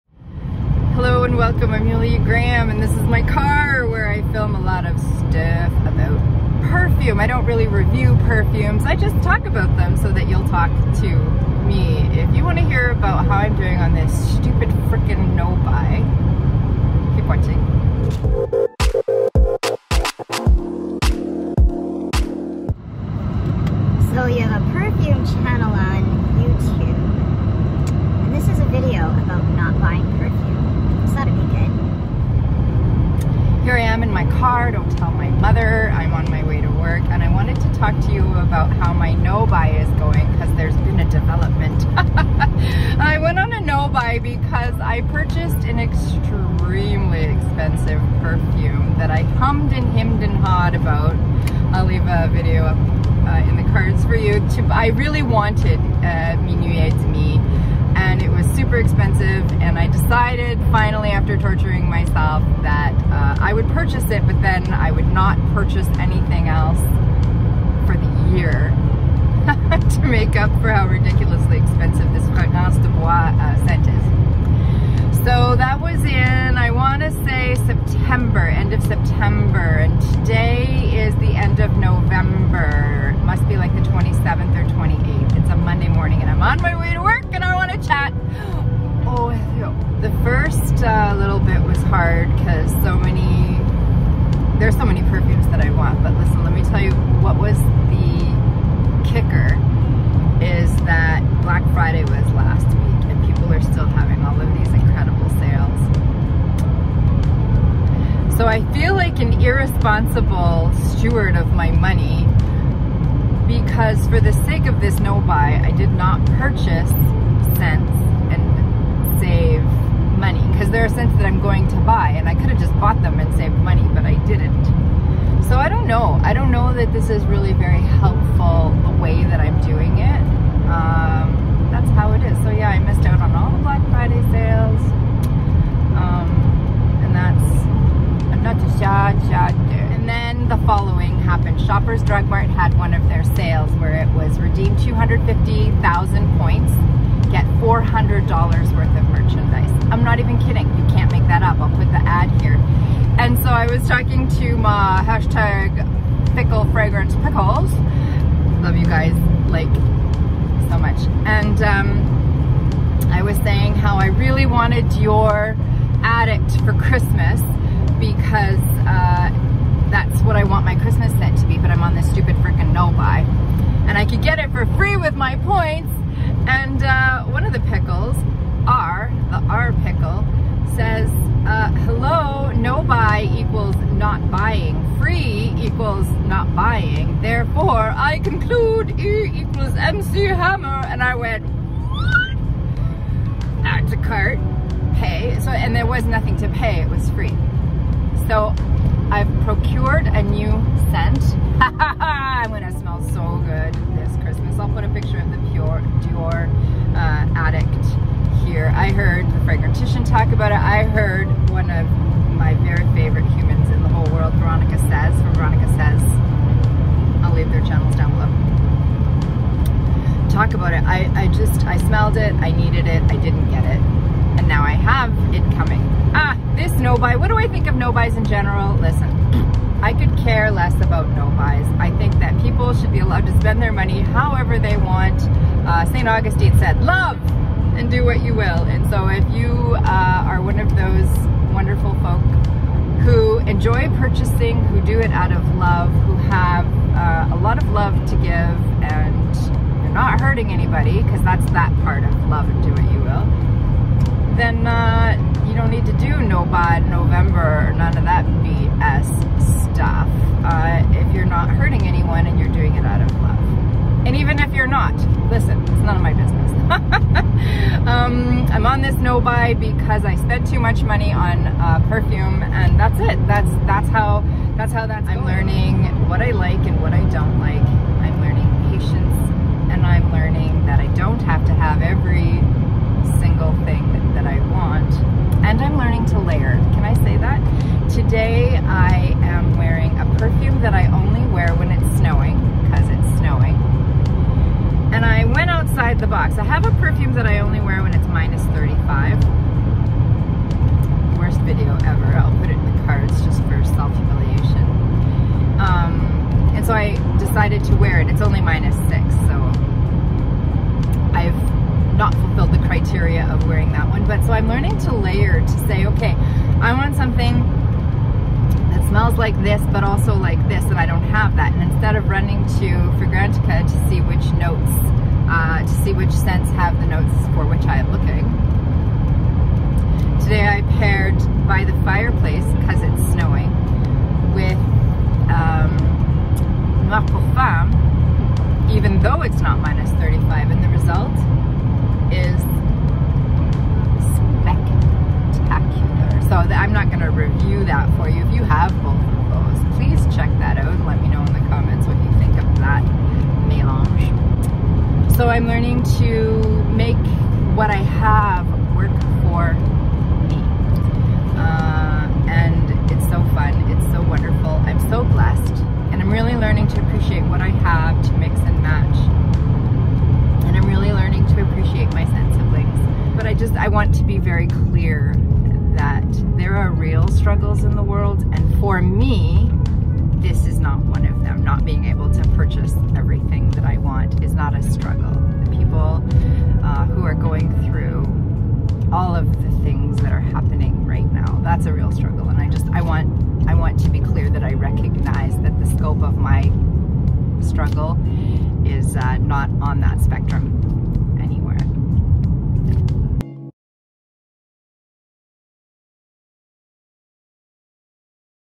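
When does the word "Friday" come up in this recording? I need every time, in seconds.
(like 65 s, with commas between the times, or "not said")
101 s, 133 s.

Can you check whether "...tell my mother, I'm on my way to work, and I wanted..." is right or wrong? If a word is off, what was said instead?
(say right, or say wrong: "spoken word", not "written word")
right.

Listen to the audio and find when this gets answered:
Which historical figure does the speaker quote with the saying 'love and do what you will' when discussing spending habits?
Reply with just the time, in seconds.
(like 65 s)
235 s.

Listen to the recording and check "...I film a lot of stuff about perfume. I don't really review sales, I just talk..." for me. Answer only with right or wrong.
wrong.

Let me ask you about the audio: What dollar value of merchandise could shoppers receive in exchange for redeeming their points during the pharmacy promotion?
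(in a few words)
$400.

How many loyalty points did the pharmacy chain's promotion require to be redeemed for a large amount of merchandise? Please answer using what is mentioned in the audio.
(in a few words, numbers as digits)
250,000.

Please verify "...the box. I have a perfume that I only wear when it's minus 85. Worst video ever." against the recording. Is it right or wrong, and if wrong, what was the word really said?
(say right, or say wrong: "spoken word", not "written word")
wrong: "35", not "85".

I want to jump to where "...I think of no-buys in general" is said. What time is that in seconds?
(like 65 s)
227 s.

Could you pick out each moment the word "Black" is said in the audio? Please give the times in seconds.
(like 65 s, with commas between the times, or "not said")
101 s, 133 s.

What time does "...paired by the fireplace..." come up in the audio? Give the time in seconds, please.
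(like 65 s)
330 s.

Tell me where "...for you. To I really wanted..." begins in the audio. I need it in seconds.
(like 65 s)
54 s.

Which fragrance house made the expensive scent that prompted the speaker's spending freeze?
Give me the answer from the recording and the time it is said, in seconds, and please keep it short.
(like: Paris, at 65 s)
Provenance de Bois, at 72 s.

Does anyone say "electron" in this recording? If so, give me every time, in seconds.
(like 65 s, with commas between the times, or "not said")
not said.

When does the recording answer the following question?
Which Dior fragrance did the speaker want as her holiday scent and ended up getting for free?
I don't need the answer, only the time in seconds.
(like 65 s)
164 s.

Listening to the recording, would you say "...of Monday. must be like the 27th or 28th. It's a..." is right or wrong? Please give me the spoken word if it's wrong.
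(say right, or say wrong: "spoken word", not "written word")
wrong: "November", not "Monday".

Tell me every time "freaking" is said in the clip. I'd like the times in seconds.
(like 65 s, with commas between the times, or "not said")
14 s, 172 s.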